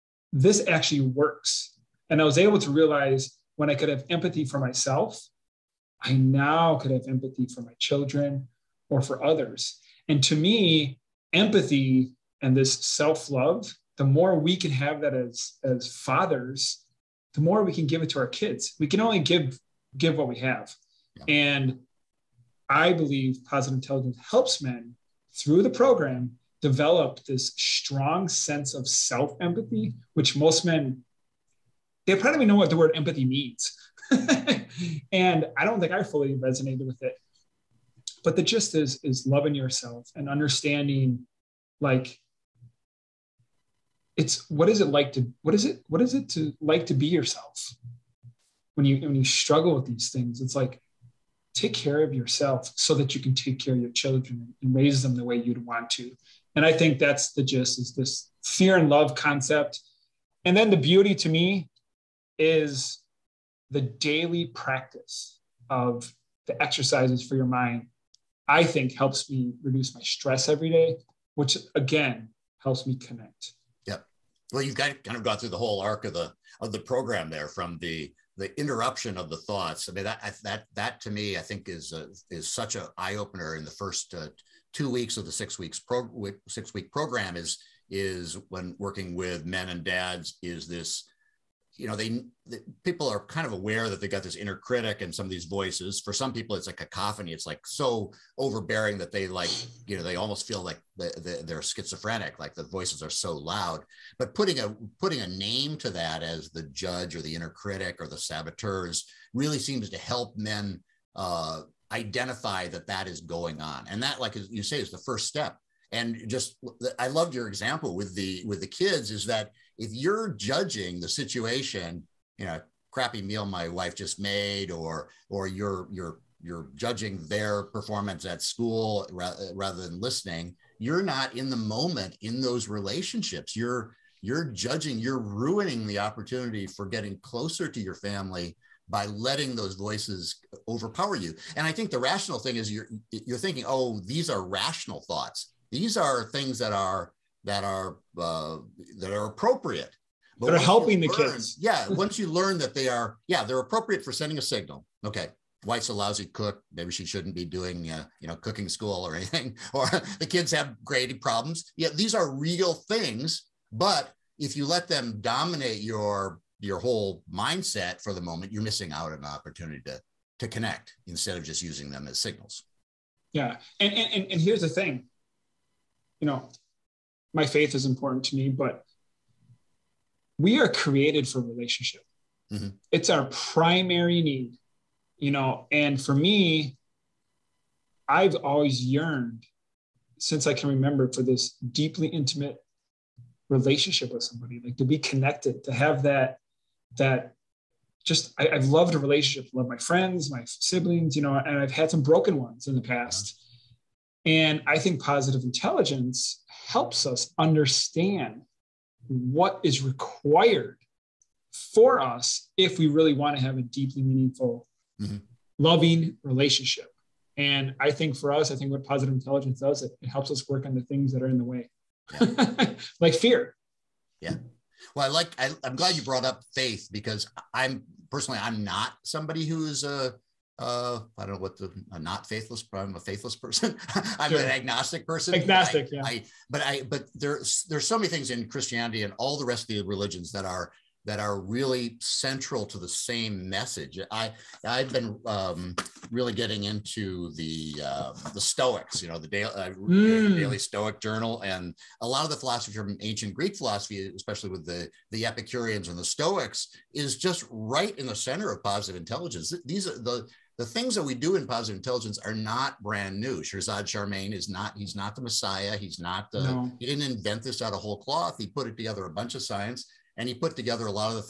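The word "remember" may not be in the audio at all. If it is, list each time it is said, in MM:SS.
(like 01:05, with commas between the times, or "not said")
03:10.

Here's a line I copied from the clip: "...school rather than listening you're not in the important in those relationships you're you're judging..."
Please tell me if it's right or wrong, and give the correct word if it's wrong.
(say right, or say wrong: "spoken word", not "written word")
wrong: "moment", not "important".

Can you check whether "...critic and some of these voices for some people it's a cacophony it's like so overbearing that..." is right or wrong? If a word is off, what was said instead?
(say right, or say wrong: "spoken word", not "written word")
right.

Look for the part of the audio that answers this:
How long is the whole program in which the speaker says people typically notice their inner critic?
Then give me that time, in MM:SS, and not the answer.
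01:26.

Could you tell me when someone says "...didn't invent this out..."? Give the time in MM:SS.
04:26.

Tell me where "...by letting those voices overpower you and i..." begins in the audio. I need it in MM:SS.
02:18.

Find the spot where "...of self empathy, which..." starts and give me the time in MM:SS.
00:28.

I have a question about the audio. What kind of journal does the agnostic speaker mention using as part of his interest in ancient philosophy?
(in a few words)
Daily Stoic Journal.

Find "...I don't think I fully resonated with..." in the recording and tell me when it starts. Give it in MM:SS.
00:35.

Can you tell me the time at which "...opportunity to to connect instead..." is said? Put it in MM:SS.
02:49.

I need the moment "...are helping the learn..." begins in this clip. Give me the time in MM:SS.
02:30.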